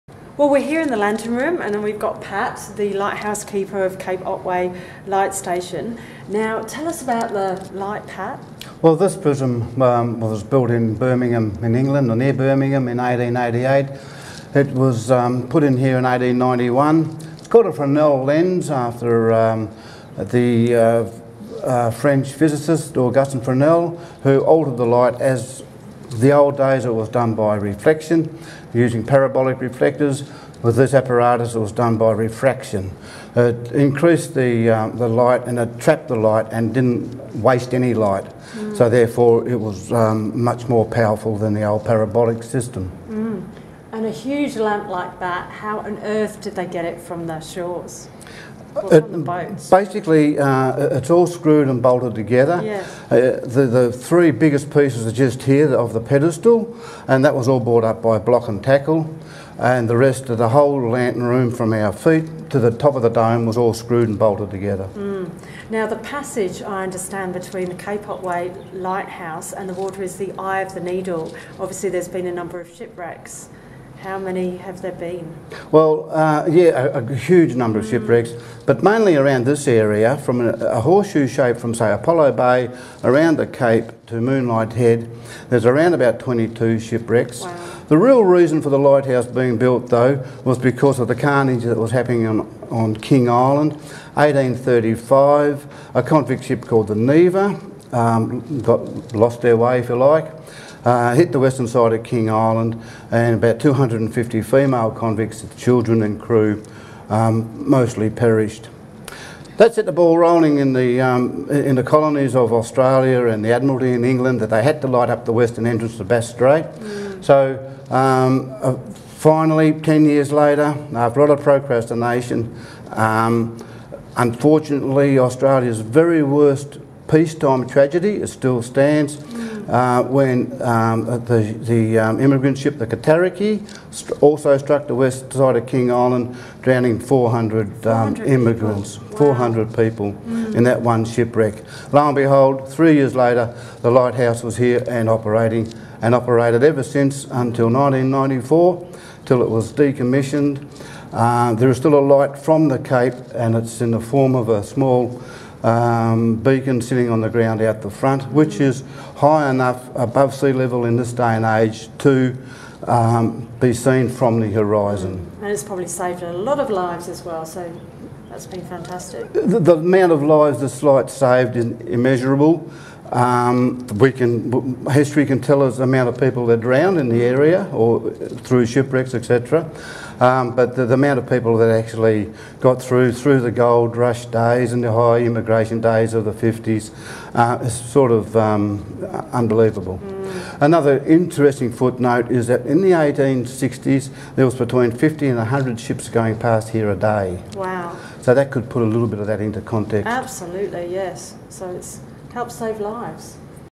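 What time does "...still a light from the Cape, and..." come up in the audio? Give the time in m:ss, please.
2:31.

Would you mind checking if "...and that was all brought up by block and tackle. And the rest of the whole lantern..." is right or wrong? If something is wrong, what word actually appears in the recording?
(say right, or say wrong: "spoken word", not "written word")
right.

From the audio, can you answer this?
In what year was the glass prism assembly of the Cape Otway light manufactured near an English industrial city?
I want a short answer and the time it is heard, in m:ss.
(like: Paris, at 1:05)
1888, at 0:12.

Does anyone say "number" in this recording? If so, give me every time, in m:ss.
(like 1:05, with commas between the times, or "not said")
1:12, 1:17.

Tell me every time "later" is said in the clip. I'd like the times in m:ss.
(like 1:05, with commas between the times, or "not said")
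2:00, 2:23.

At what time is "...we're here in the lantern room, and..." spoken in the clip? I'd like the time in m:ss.
0:00.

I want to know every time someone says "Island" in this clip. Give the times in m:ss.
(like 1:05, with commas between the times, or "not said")
1:33, 1:42, 2:15.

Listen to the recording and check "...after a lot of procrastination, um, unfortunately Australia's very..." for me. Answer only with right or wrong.
right.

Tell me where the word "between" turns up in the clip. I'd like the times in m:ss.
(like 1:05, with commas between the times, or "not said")
1:07, 3:14.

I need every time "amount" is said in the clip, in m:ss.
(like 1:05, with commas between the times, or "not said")
2:49, 2:55, 3:00.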